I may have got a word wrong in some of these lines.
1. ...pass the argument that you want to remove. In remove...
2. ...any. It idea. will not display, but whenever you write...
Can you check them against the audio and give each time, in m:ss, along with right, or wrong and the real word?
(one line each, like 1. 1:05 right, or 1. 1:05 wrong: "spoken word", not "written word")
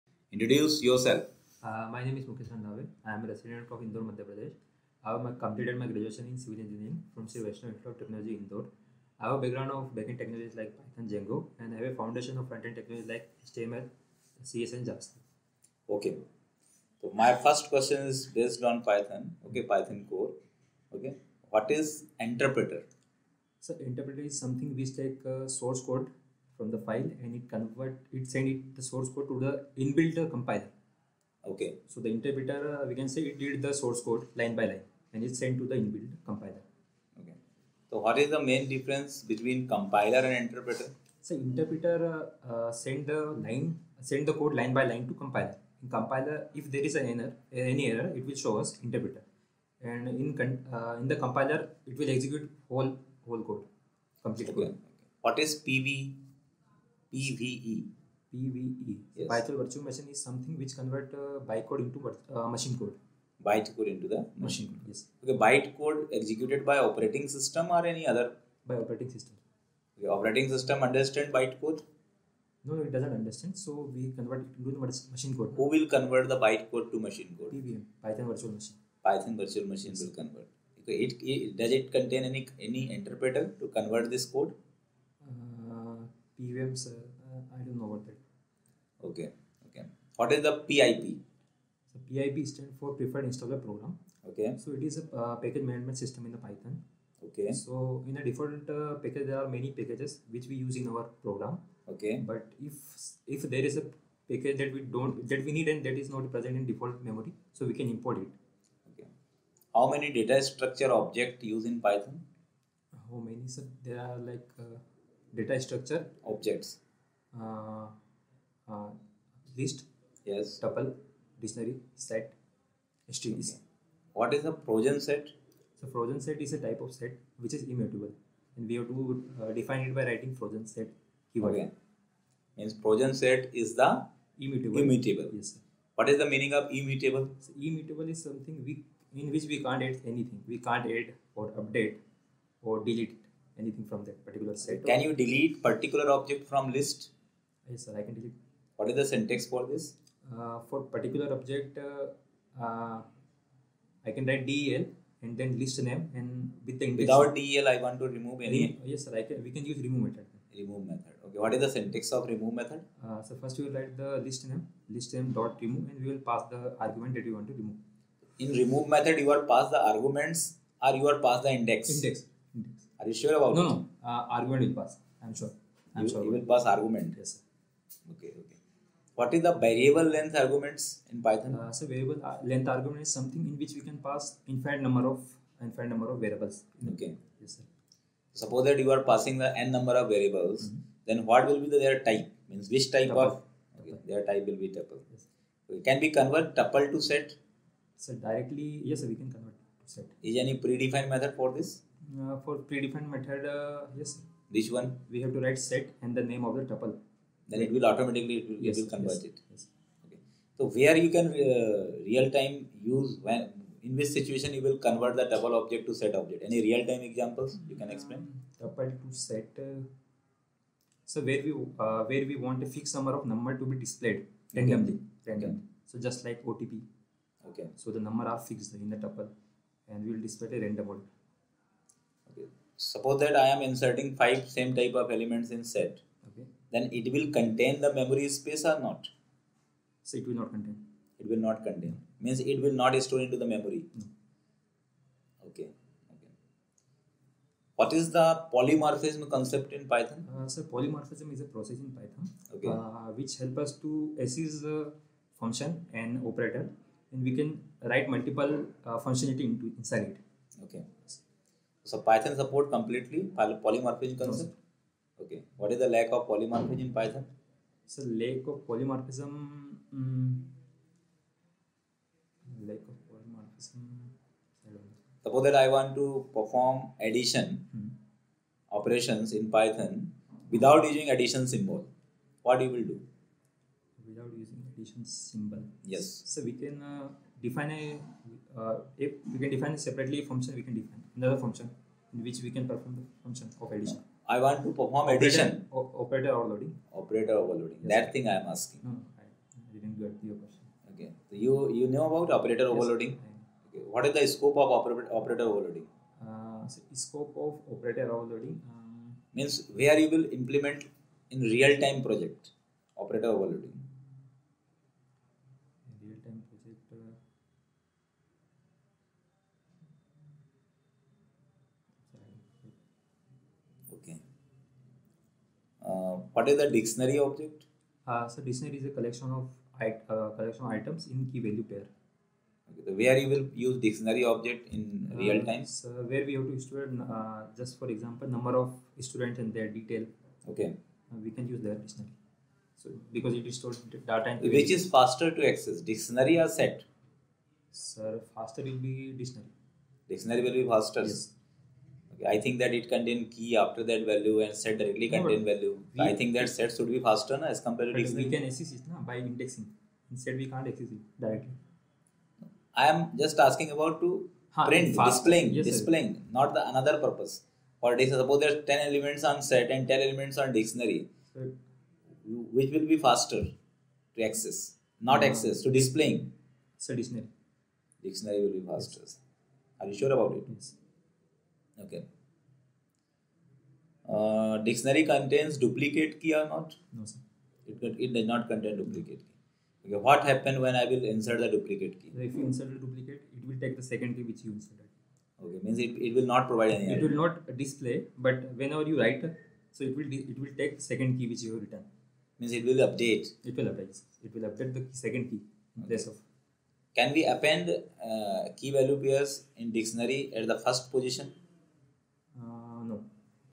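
1. 2:46 right
2. 6:36 right.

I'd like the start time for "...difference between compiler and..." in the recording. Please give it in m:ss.
0:38.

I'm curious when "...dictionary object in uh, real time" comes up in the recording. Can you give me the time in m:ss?
5:33.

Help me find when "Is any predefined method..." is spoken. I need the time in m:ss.
3:20.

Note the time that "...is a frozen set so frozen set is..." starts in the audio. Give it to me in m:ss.
2:04.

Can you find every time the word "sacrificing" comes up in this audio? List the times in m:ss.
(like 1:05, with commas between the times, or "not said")
not said.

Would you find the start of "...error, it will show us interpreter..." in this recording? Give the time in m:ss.
0:47.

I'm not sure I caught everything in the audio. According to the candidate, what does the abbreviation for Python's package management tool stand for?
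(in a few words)
Preferred Installer Program.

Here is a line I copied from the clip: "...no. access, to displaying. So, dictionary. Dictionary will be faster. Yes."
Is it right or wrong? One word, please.
right.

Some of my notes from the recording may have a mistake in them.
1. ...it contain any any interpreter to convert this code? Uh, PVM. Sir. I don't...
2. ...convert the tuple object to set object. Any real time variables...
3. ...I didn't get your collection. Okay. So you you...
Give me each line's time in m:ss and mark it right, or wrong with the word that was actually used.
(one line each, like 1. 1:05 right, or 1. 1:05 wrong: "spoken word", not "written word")
1. 1:21 right
2. 3:34 wrong: "examples", not "variables"
3. 4:59 wrong: "question", not "collection".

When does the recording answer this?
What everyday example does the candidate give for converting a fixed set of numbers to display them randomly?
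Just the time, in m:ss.
3:46.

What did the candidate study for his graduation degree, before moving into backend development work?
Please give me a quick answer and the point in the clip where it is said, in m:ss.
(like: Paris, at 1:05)
Civil engineering, at 0:06.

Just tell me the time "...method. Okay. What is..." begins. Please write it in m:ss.
2:40.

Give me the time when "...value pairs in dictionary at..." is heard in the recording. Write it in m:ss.
6:48.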